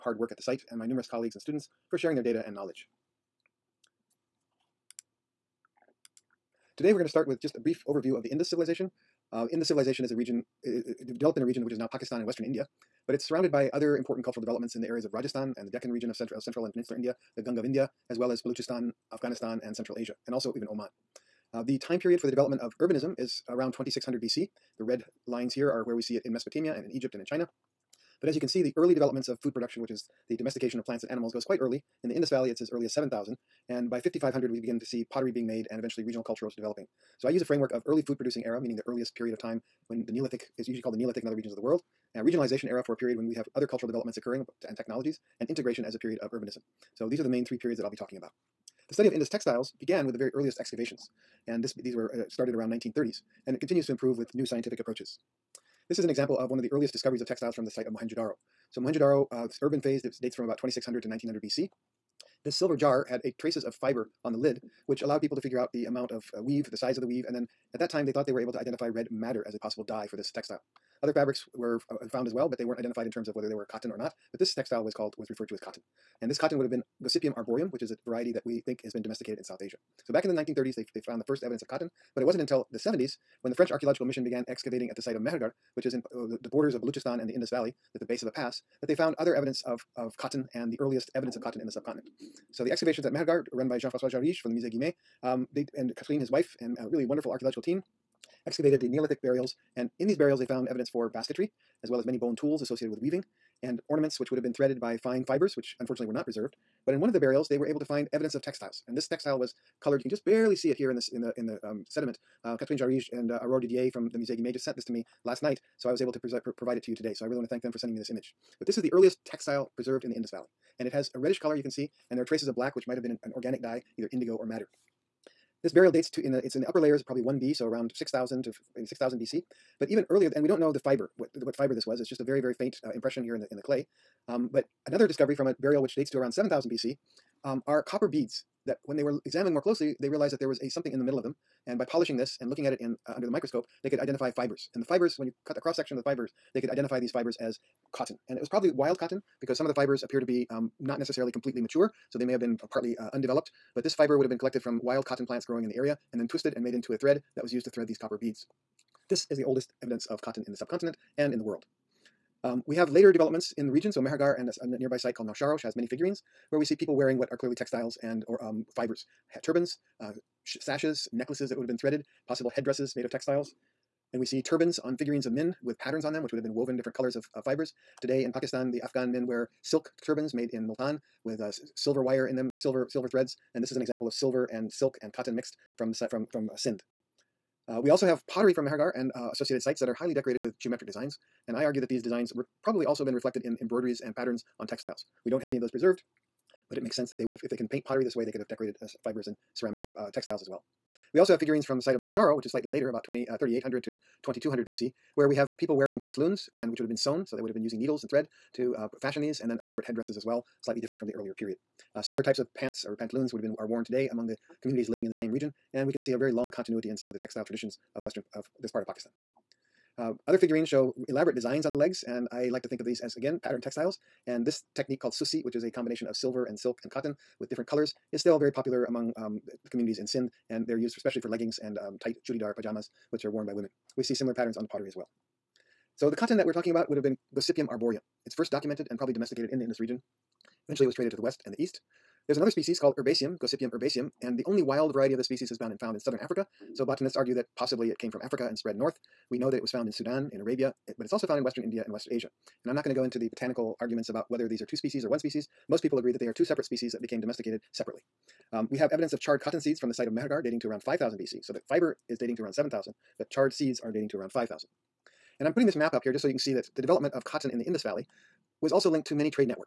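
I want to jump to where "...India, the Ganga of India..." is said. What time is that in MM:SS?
00:16.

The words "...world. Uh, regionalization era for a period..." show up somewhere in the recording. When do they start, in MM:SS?
00:41.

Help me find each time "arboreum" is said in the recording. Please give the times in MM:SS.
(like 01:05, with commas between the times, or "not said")
01:17, 03:57.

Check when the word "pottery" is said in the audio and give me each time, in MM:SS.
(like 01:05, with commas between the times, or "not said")
00:35, 03:08, 03:17, 03:54.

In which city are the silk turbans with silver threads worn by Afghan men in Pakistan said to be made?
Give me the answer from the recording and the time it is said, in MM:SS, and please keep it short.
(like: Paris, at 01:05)
Multan, at 03:00.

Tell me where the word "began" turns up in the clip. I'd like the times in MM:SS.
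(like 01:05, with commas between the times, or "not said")
00:49, 01:24.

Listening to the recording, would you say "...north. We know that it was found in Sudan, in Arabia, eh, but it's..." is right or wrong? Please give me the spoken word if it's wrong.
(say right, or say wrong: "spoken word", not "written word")
right.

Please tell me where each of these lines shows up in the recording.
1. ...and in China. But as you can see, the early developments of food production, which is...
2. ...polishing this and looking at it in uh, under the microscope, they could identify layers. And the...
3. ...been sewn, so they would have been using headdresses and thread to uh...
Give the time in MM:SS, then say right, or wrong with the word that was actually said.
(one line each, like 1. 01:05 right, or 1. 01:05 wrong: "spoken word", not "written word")
1. 00:27 right
2. 02:21 wrong: "fibers", not "layers"
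3. 03:26 wrong: "needles", not "headdresses".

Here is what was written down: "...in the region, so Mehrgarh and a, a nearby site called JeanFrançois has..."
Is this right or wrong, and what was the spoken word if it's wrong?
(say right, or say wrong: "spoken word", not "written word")
wrong: "Nausharosh", not "JeanFrançois".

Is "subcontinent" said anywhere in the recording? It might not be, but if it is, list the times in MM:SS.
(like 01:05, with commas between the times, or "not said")
01:31, 02:40.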